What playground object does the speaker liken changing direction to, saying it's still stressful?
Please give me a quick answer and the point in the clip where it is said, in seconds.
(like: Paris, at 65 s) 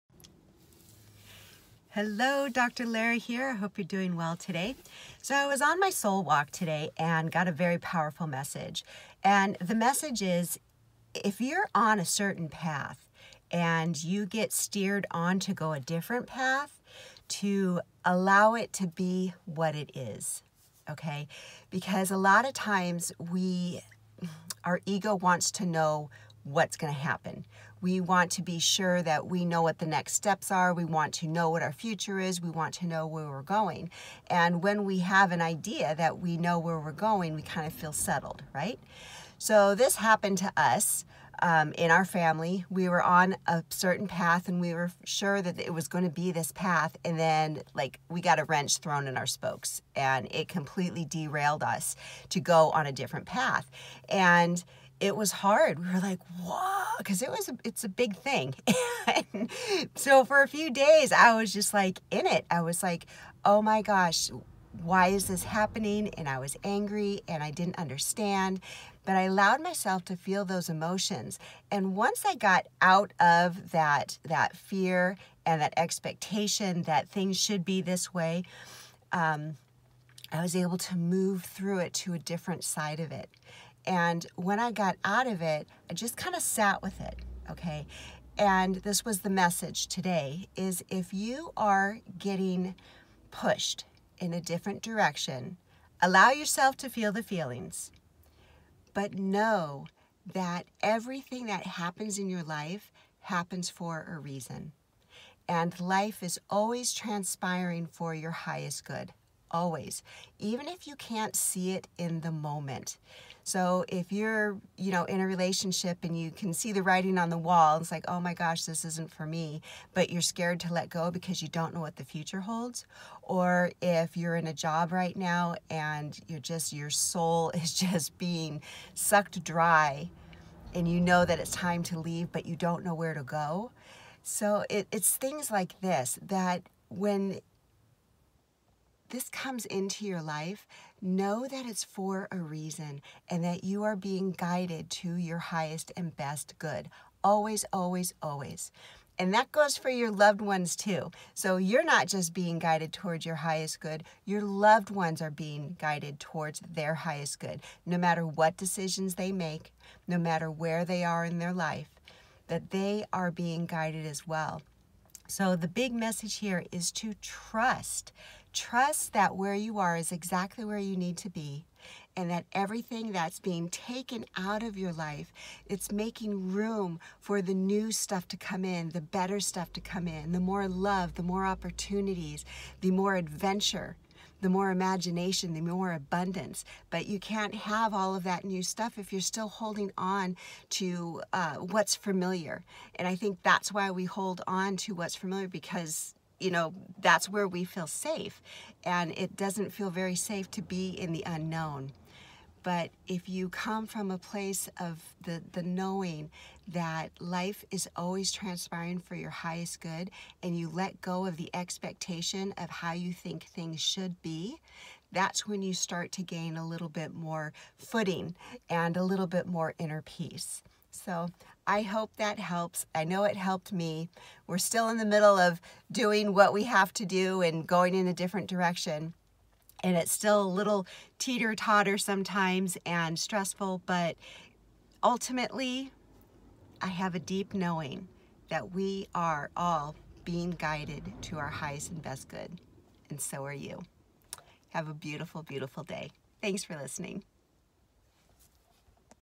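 teeter totter, at 231 s.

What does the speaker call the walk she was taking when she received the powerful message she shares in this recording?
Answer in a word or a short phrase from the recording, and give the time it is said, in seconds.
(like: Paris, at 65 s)
soul walk, at 5 s.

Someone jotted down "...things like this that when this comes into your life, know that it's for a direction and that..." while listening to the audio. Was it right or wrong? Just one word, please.
wrong.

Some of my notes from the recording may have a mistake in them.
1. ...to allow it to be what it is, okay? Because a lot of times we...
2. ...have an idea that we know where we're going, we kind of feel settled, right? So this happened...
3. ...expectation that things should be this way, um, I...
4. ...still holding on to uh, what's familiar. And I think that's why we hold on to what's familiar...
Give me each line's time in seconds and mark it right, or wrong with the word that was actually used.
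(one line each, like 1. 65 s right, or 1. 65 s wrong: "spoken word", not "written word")
1. 17 s right
2. 34 s right
3. 75 s right
4. 189 s right.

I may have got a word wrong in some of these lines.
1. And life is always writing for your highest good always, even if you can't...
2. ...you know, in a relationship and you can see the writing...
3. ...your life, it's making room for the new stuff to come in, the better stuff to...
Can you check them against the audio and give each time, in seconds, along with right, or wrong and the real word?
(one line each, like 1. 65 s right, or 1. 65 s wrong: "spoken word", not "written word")
1. 105 s wrong: "transpiring", not "writing"
2. 114 s right
3. 174 s right.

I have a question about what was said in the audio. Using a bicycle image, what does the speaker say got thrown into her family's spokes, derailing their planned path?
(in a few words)
a wrench.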